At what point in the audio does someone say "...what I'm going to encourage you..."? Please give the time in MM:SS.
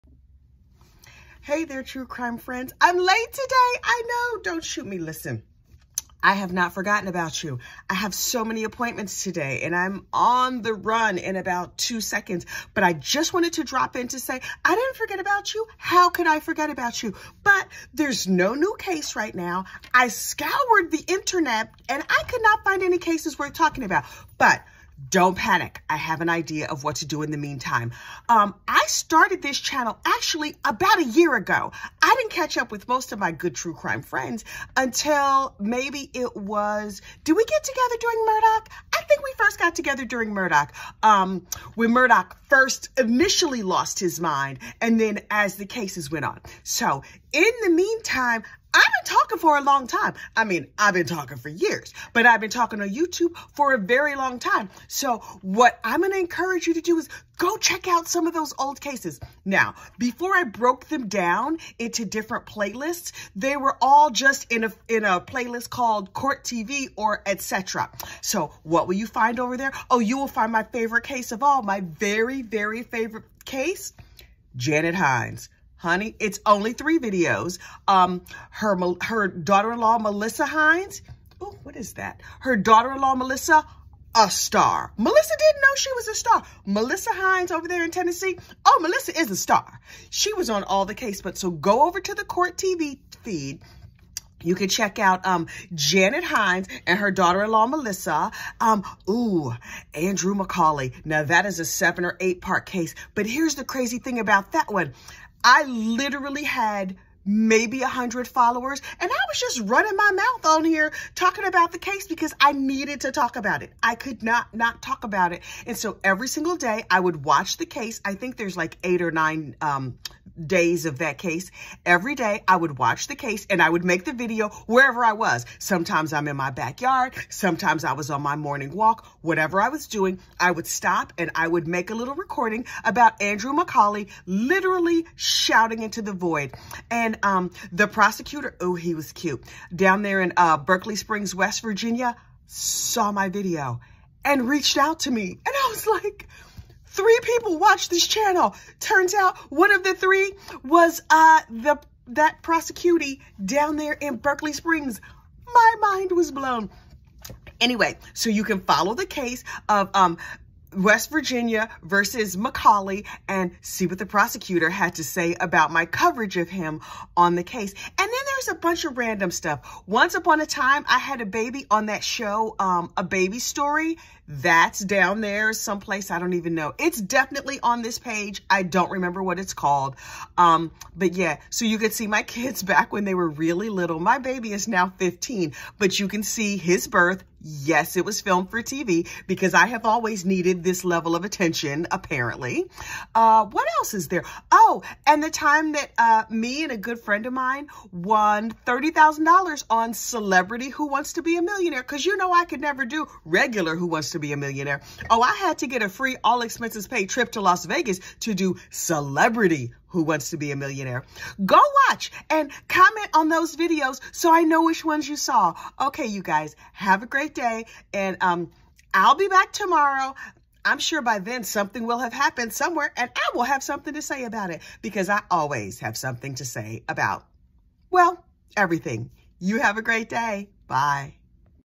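00:55.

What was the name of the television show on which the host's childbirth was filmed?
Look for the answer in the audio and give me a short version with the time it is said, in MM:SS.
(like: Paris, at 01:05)
A Baby Story, at 02:52.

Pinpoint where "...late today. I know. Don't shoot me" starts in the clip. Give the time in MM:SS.
00:02.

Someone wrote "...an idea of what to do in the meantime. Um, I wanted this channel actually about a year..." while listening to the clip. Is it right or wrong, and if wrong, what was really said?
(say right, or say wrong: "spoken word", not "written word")
wrong: "started", not "wanted".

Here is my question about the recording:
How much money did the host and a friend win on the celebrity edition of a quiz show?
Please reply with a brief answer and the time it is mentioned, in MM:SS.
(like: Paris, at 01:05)
$30,000, at 03:18.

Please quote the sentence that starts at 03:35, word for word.
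Okay, you guys, have a great day.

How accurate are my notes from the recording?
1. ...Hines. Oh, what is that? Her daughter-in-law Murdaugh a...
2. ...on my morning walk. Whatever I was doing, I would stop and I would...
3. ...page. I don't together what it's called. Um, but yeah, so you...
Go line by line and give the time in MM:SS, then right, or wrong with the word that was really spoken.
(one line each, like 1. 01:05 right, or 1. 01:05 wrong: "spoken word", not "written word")
1. 01:20 wrong: "Melissa", not "Murdaugh"
2. 02:08 right
3. 02:57 wrong: "remember", not "together".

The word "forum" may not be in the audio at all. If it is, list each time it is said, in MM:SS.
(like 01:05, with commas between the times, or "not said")
not said.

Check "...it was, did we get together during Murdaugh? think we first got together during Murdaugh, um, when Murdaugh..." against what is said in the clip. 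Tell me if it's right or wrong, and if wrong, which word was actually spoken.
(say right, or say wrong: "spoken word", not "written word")
right.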